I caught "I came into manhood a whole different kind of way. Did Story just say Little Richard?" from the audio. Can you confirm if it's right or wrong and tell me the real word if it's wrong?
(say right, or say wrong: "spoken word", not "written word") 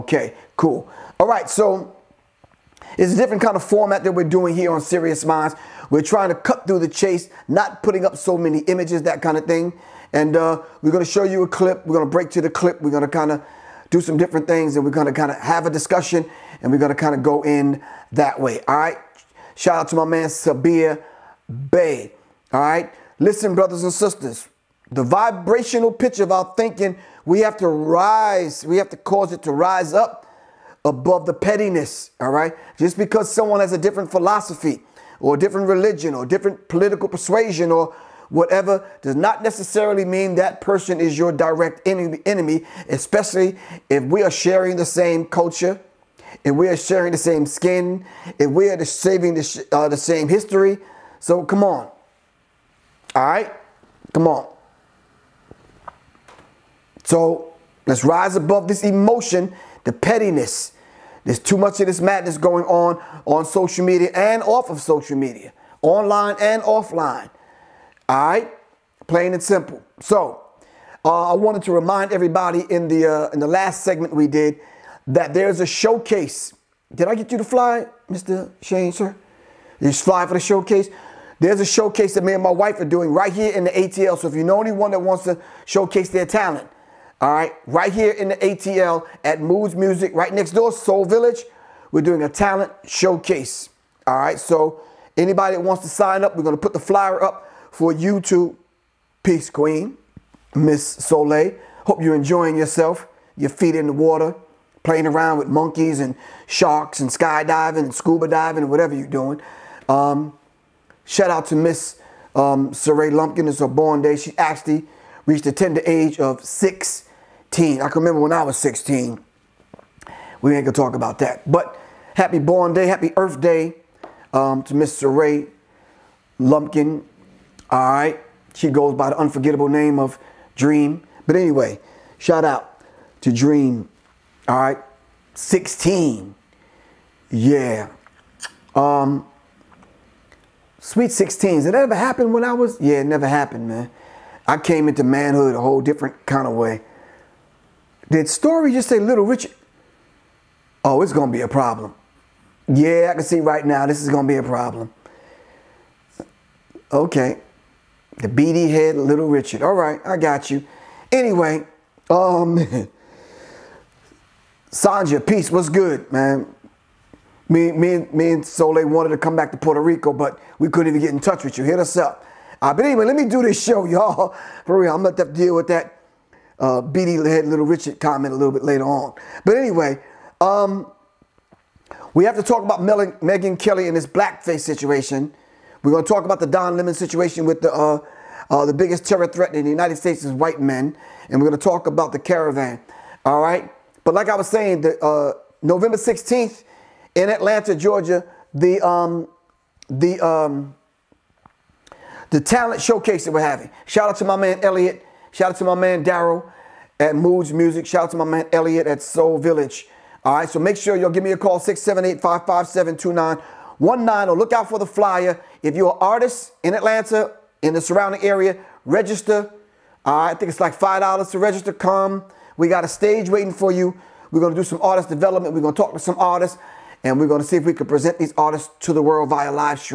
right.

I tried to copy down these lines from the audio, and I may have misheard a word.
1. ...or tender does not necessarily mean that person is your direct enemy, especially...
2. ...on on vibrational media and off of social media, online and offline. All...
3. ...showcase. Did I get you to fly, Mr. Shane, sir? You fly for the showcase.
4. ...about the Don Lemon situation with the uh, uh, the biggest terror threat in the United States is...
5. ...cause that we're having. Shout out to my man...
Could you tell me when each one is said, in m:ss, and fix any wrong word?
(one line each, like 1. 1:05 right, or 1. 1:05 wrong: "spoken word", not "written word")
1. 0:37 wrong: "whatever", not "tender"
2. 1:02 wrong: "social", not "vibrational"
3. 1:15 right
4. 3:06 right
5. 3:22 wrong: "showcase", not "cause".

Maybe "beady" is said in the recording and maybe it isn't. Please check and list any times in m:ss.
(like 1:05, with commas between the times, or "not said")
2:38, 2:56.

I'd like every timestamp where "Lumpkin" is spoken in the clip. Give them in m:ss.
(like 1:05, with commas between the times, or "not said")
1:53, 2:06.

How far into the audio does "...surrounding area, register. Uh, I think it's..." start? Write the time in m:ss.
3:37.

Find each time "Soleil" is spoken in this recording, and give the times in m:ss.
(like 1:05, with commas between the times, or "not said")
1:40, 2:48.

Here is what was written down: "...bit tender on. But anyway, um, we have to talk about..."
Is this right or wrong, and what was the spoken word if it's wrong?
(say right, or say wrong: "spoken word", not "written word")
wrong: "later", not "tender".